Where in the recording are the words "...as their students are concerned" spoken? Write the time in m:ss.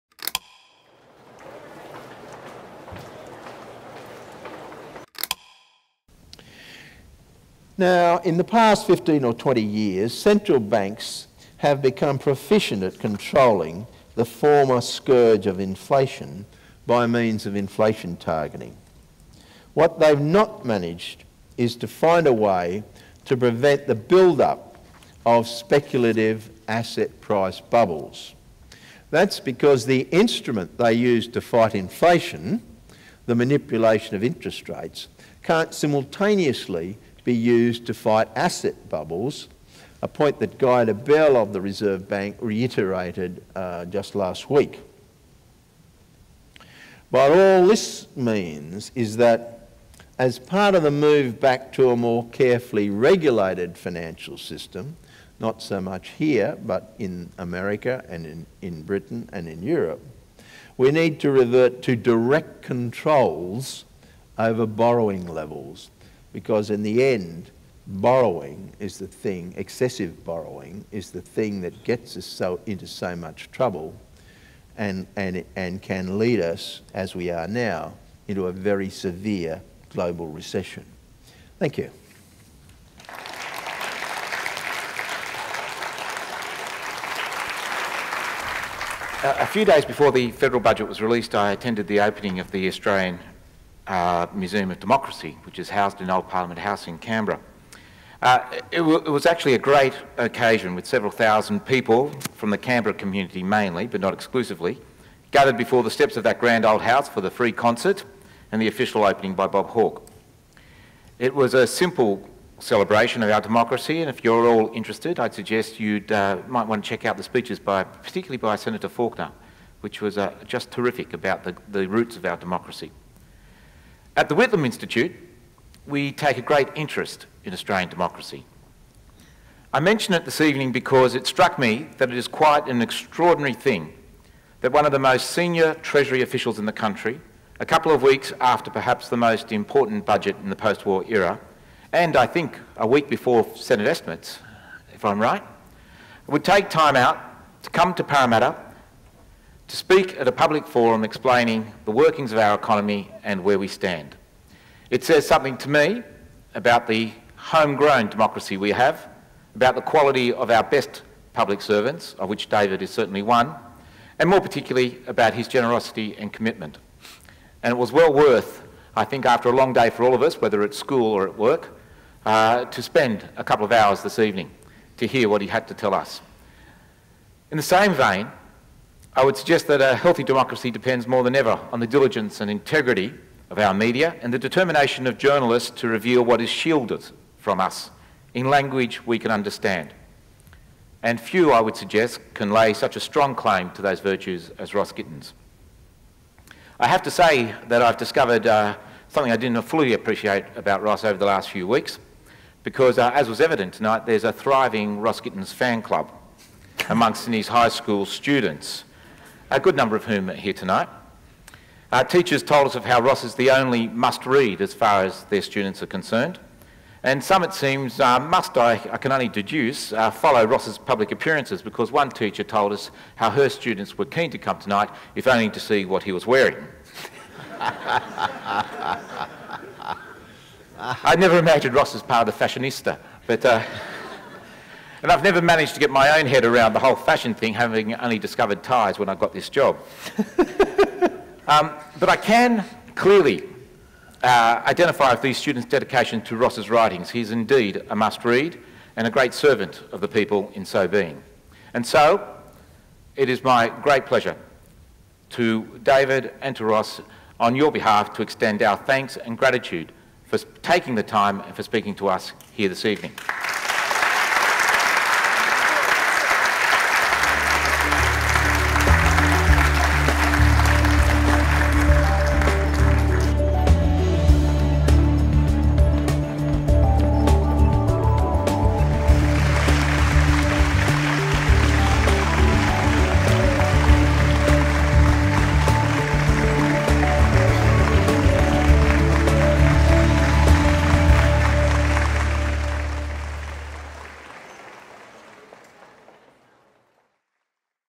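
3:35.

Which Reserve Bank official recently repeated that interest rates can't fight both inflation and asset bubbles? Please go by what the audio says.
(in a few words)
Guy Debelle.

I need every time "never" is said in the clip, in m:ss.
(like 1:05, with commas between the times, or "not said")
3:51, 3:55.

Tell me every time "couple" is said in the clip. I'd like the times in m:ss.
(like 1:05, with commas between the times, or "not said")
2:17, 2:53.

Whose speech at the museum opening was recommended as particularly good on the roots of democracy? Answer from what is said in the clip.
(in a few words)
Senator Faulkner.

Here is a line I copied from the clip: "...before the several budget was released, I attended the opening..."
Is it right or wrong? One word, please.
wrong.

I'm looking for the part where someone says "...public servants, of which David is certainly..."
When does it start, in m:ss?
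2:41.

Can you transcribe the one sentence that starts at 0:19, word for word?
What they've not managed is to find a way to prevent the build-up of speculative asset price bubbles.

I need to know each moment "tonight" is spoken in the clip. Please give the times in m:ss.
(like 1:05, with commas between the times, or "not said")
3:23, 3:30, 3:44.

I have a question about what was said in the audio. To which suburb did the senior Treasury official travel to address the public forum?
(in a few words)
Parramatta.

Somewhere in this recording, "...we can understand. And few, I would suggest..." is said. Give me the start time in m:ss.
3:09.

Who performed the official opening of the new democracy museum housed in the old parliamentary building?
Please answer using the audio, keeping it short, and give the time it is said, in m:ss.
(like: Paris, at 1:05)
Bob Hawke, at 1:49.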